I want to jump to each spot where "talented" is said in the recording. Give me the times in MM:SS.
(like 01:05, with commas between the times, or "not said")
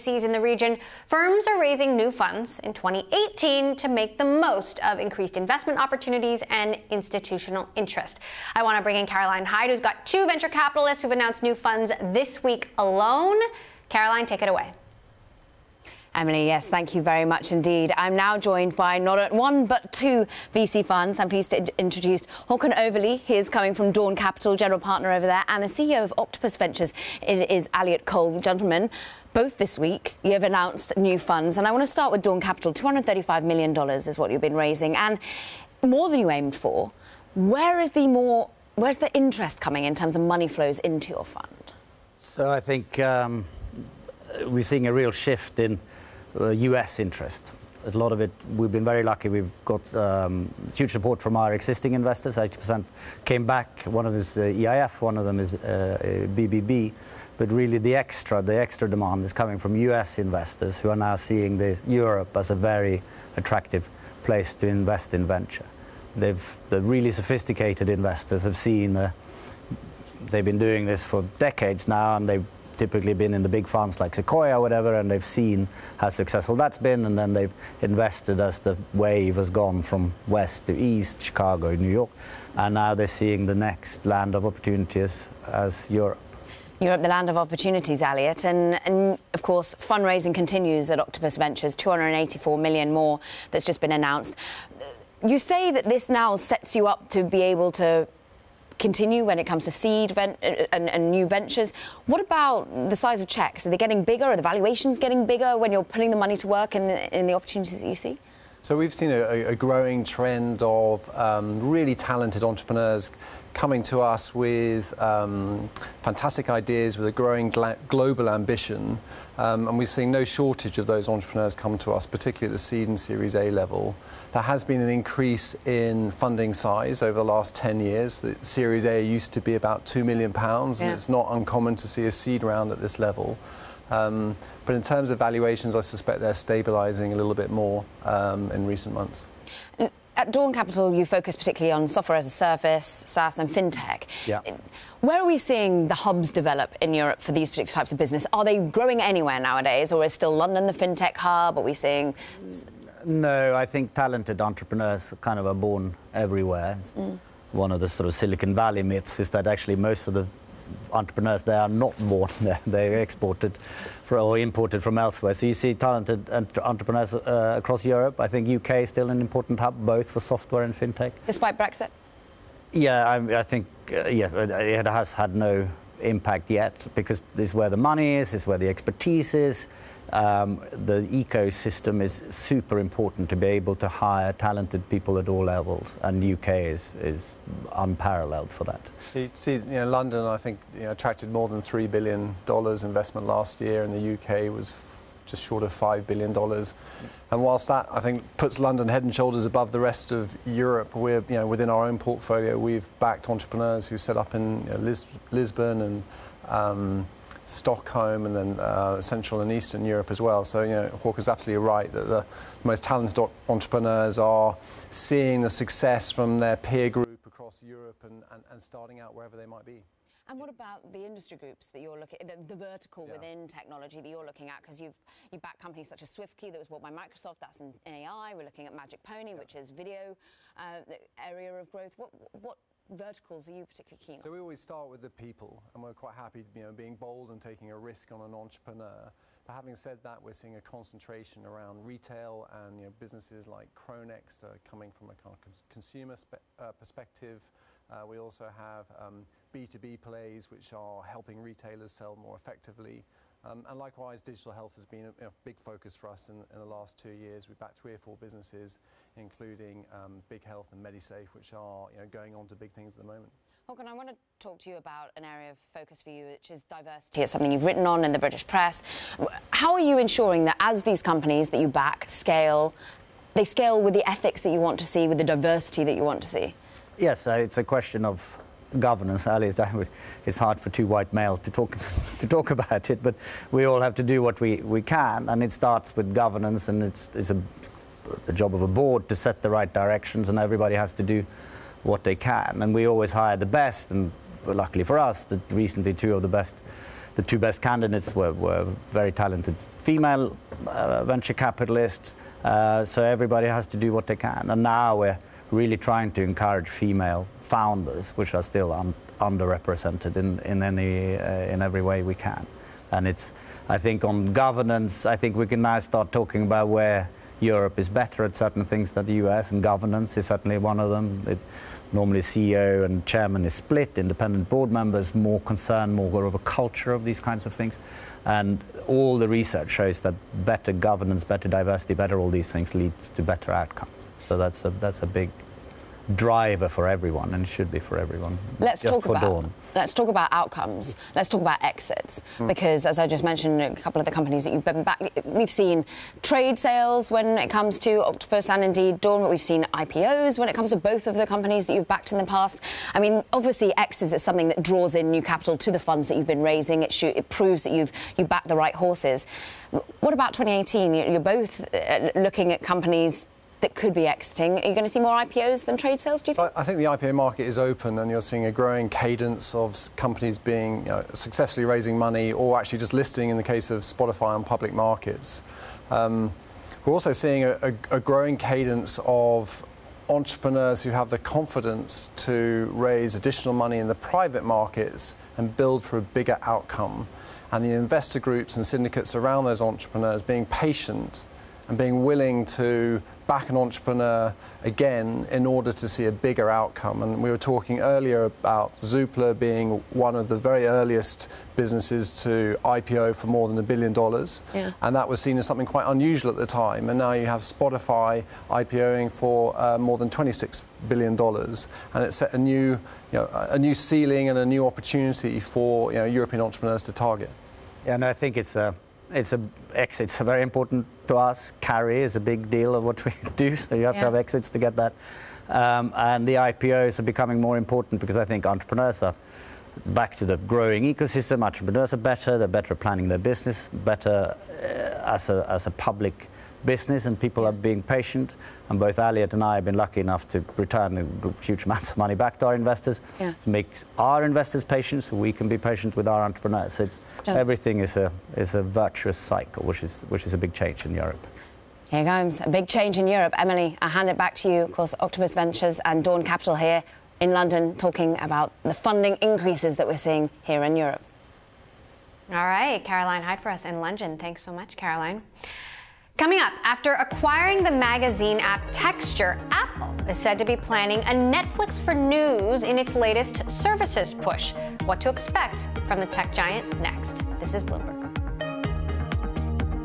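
01:51, 02:33, 02:45, 03:04, 03:32, 04:59.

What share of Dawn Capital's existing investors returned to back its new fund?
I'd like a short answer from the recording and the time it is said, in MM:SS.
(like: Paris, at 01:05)
80%, at 00:52.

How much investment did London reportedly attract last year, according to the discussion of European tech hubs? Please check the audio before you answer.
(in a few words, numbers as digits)
$3 billion.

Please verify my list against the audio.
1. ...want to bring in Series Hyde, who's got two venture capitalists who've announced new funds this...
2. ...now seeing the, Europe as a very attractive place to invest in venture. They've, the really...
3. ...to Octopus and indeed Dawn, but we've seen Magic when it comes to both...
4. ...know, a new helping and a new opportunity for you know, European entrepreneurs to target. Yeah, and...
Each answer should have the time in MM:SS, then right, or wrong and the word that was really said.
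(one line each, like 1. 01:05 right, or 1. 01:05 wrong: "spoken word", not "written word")
1. 00:08 wrong: "Caroline", not "Series"
2. 01:00 right
3. 05:47 wrong: "IPOs", not "Magic"
4. 06:53 wrong: "ceiling", not "helping".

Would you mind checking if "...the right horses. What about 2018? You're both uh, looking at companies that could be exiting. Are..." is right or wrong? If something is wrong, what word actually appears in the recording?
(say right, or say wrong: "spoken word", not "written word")
right.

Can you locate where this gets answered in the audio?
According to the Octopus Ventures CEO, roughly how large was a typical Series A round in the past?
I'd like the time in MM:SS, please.
02:09.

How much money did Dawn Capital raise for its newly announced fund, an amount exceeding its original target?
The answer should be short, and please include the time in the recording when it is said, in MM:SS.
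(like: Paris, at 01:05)
$235 million, at 00:32.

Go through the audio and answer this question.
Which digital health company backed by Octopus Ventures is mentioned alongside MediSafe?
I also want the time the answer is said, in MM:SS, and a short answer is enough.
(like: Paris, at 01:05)
Big Health, at 04:20.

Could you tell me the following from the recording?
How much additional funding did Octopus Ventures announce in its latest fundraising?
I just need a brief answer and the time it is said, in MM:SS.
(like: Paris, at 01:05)
284 million, at 01:31.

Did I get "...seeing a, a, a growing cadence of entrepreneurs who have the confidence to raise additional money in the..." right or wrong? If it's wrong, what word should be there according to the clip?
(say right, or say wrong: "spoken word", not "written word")
right.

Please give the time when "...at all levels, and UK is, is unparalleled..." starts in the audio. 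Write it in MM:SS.
03:05.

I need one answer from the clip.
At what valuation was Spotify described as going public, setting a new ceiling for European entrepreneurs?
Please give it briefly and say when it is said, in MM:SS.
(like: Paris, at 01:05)
$26 billion, at 06:50.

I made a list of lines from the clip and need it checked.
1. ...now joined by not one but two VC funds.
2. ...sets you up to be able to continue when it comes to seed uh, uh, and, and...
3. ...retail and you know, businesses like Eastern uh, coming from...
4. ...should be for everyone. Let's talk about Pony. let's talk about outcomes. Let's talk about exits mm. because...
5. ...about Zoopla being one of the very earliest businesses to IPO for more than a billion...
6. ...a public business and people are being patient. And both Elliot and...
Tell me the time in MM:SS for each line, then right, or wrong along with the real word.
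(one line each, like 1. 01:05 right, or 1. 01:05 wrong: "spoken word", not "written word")
1. 00:18 right
2. 01:36 right
3. 04:01 wrong: "Cronex", not "Eastern"
4. 05:37 wrong: "Dawn", not "Pony"
5. 06:38 right
6. 07:15 right.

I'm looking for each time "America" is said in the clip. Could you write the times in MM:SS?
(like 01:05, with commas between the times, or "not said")
not said.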